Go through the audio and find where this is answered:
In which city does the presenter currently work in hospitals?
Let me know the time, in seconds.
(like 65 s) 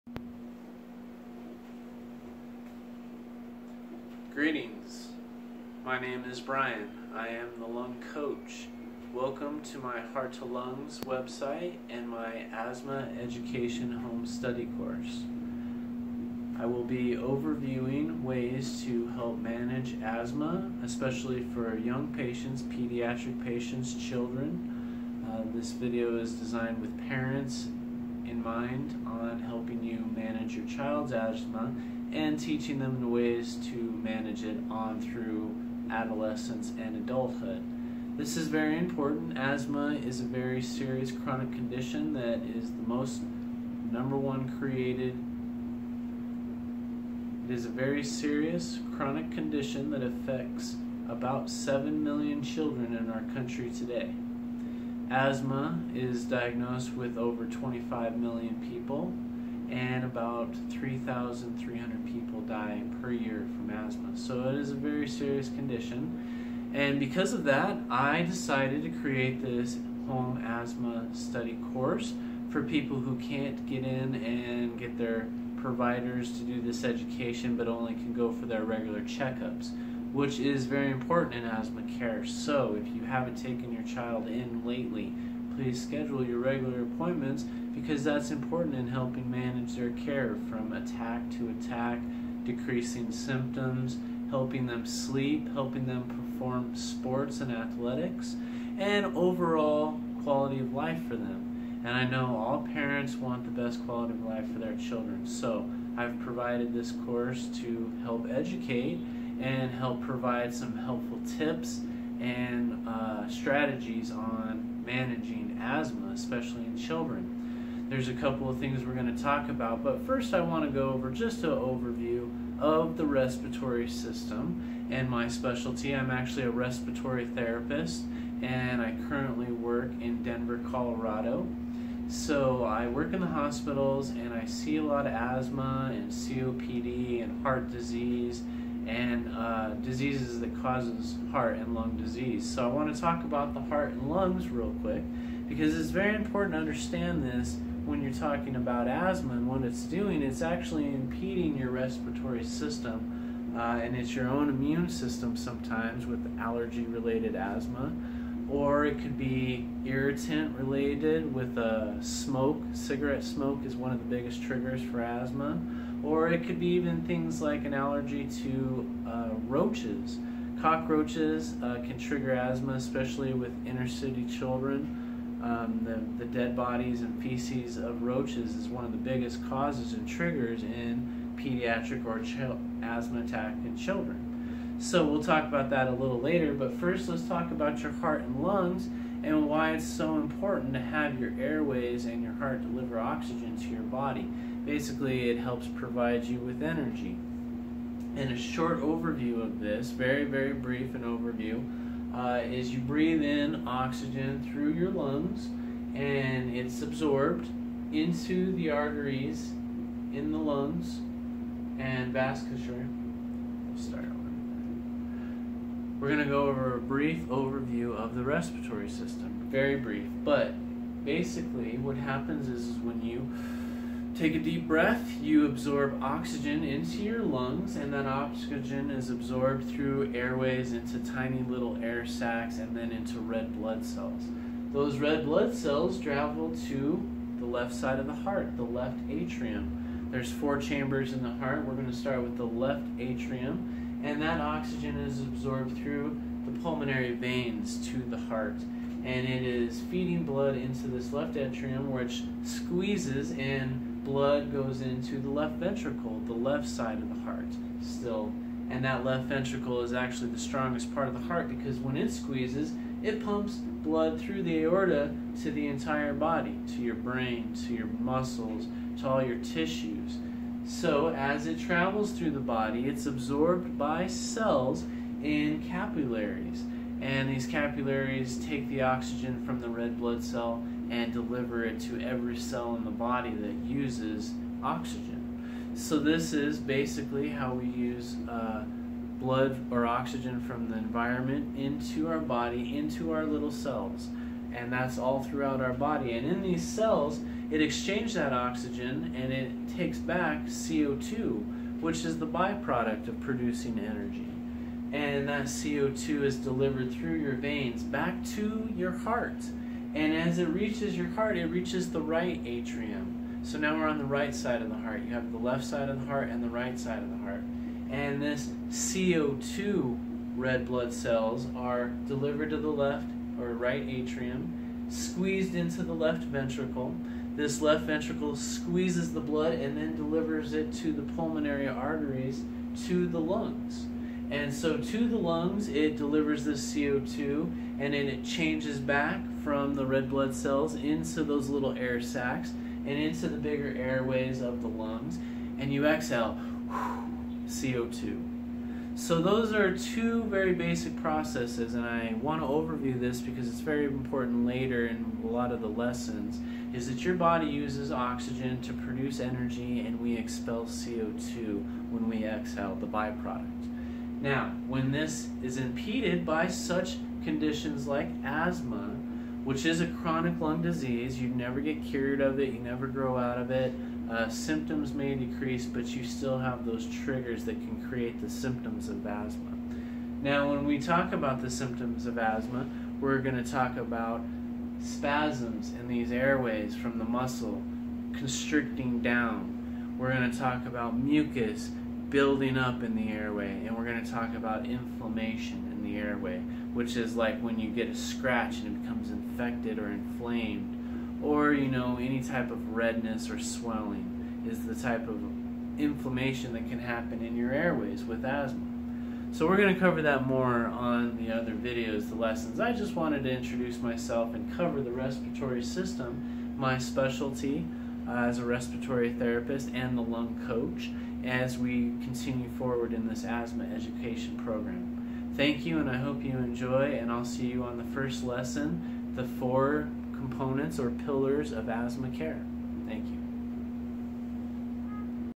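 130 s.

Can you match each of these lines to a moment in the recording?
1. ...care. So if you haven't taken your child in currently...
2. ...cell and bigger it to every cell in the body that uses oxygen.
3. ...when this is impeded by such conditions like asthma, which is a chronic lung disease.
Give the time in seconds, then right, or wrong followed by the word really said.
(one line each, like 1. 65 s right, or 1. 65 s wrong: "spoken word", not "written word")
1. 81 s wrong: "lately", not "currently"
2. 280 s wrong: "deliver", not "bigger"
3. 364 s right.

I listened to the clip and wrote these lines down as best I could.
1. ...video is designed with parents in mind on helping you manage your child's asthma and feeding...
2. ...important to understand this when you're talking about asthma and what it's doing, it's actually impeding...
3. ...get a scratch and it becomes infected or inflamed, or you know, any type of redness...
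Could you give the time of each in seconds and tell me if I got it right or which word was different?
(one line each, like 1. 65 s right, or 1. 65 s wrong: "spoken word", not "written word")
1. 25 s wrong: "teaching", not "feeding"
2. 146 s right
3. 397 s right.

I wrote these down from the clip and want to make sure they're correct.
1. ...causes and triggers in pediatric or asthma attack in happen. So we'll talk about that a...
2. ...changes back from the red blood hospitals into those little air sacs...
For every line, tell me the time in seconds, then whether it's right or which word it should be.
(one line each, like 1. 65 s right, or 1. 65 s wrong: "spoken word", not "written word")
1. 179 s wrong: "children", not "happen"
2. 338 s wrong: "cells", not "hospitals".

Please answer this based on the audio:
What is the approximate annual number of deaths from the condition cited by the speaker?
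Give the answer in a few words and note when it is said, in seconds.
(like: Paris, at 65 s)
3,300, at 60 s.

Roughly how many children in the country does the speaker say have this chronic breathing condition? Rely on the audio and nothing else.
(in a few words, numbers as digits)
7 million.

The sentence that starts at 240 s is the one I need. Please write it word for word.
There's four chambers in the heart.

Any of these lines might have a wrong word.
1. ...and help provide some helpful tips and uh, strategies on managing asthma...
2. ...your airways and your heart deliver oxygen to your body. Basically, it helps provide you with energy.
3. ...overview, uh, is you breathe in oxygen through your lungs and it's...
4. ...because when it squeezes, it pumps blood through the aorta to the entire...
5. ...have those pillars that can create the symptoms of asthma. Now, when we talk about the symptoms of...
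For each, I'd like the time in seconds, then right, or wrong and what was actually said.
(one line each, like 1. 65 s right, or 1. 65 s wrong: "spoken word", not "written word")
1. 109 s right
2. 191 s right
3. 201 s right
4. 261 s right
5. 376 s wrong: "triggers", not "pillars".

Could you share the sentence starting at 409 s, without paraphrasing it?
So we're going to cover that more on the other videos, the lessons.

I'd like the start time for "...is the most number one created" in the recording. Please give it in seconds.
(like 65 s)
42 s.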